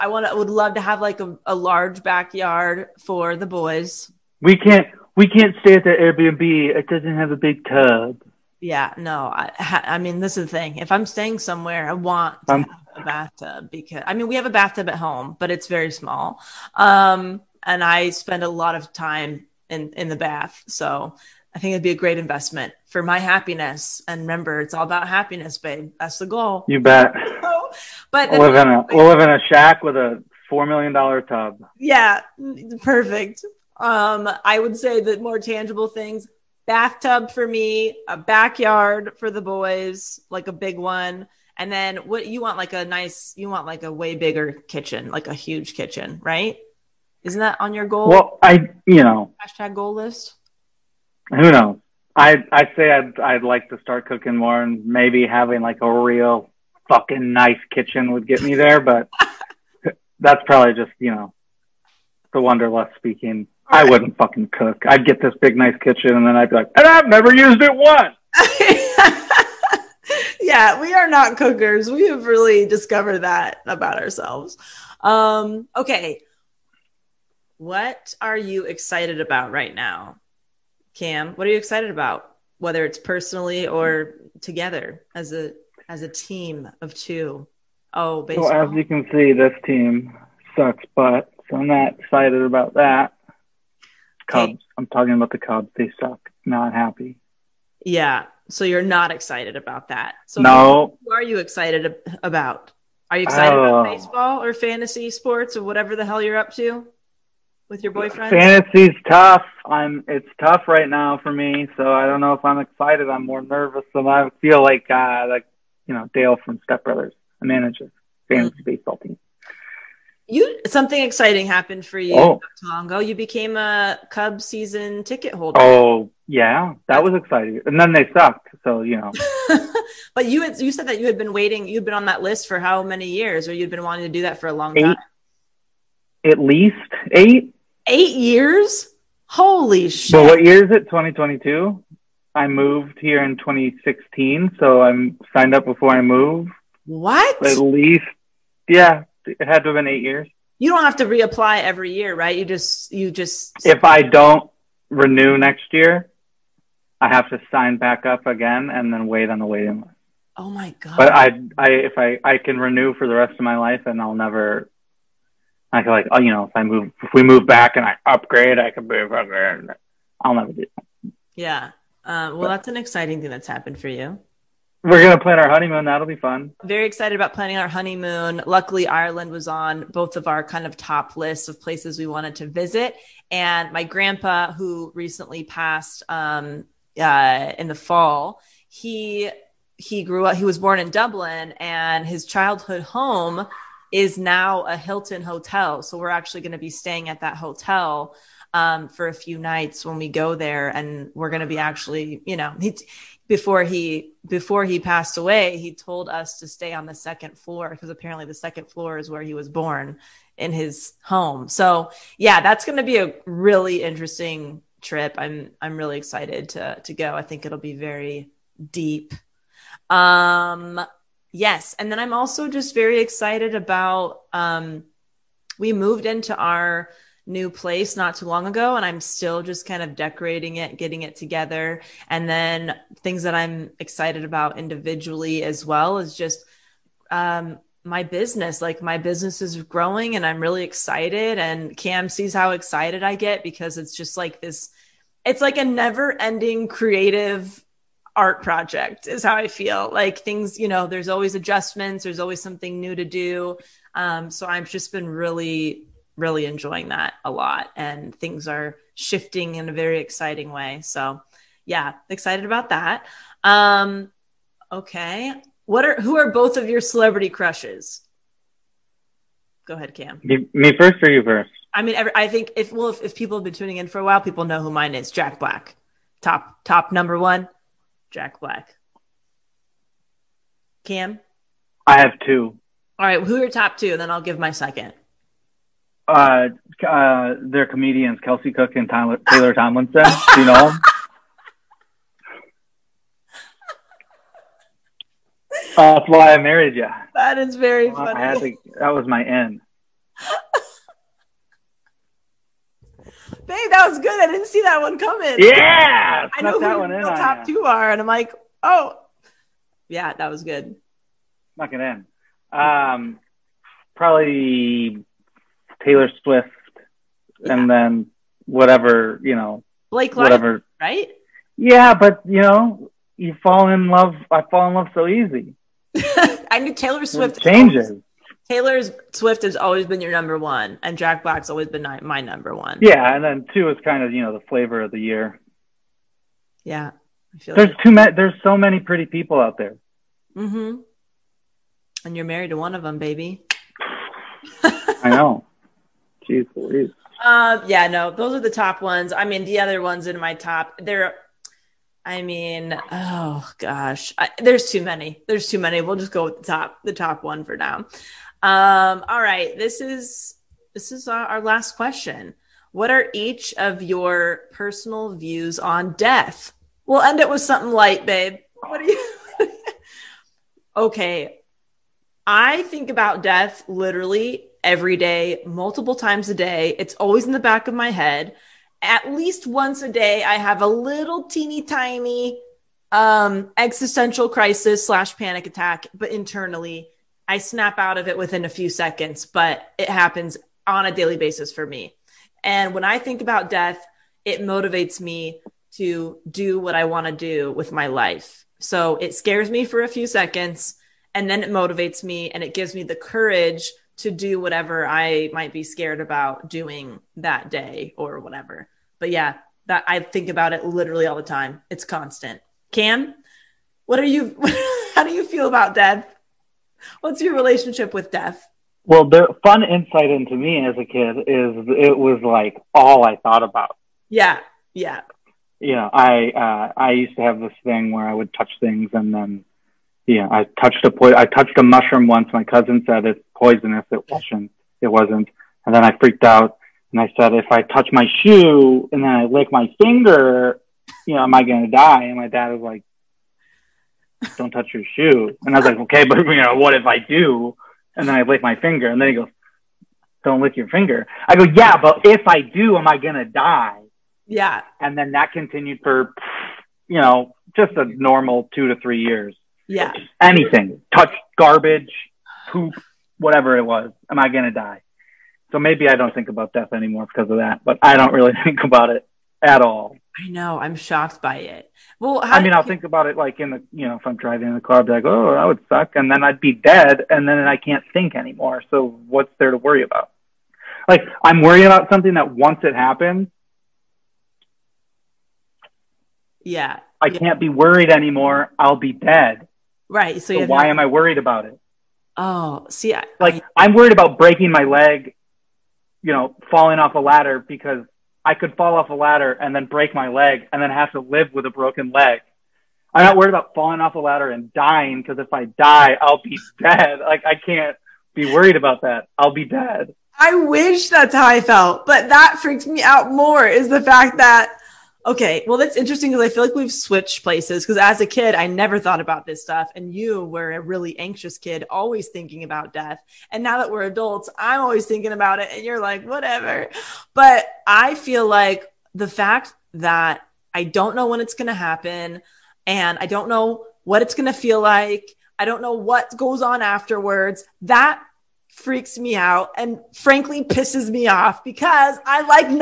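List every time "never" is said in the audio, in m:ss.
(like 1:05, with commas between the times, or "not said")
1:07, 2:44, 2:50, 4:05, 8:38.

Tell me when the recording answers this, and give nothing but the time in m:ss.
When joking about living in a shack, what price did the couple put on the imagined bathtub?
0:30.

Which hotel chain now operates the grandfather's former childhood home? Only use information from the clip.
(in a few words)
Hilton.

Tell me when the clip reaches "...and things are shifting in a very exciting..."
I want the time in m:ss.
4:17.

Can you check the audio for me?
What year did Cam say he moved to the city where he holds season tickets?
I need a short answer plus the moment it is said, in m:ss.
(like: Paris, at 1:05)
2016, at 2:23.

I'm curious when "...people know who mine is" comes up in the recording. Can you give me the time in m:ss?
4:34.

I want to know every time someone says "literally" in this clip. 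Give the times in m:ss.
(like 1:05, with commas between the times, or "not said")
6:13, 6:50.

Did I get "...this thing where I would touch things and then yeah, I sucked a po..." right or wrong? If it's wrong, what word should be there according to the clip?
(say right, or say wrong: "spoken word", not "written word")
wrong: "touched", not "sucked".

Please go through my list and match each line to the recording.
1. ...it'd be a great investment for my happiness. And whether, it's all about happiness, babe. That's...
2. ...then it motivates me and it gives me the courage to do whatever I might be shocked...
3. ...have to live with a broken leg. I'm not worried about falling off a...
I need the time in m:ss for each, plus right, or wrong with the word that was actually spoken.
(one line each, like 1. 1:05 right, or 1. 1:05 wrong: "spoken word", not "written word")
1. 0:21 wrong: "remember", not "whether"
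2. 6:41 wrong: "scared", not "shocked"
3. 8:20 right.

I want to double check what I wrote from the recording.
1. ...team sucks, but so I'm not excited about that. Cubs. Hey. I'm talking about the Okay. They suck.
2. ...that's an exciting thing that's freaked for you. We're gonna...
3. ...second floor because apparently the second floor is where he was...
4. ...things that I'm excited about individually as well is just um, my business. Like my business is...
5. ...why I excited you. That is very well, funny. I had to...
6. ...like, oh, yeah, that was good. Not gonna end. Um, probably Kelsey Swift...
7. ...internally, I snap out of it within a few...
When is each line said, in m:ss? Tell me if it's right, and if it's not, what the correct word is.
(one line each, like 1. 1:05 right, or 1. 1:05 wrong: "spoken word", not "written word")
1. 1:29 wrong: "Cubs", not "Okay"
2. 2:52 wrong: "happened", not "freaked"
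3. 3:26 right
4. 3:53 right
5. 4:56 wrong: "married", not "excited"
6. 5:08 wrong: "Taylor", not "Kelsey"
7. 6:26 right.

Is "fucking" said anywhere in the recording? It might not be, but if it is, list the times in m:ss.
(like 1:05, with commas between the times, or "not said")
0:56, 1:04.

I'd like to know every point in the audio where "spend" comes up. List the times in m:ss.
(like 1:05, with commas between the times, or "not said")
0:18.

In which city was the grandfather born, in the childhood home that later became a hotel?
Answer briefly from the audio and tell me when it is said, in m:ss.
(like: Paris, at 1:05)
Dublin, at 3:10.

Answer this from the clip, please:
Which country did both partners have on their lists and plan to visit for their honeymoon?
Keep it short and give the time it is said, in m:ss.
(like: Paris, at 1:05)
Ireland, at 2:58.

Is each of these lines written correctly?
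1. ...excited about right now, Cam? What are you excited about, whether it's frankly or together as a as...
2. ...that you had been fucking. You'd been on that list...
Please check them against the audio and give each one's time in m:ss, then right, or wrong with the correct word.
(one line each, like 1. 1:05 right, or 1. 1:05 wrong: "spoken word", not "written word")
1. 1:18 wrong: "personally", not "frankly"
2. 2:10 wrong: "waiting", not "fucking".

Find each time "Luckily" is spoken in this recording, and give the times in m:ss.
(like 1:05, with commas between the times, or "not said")
2:58.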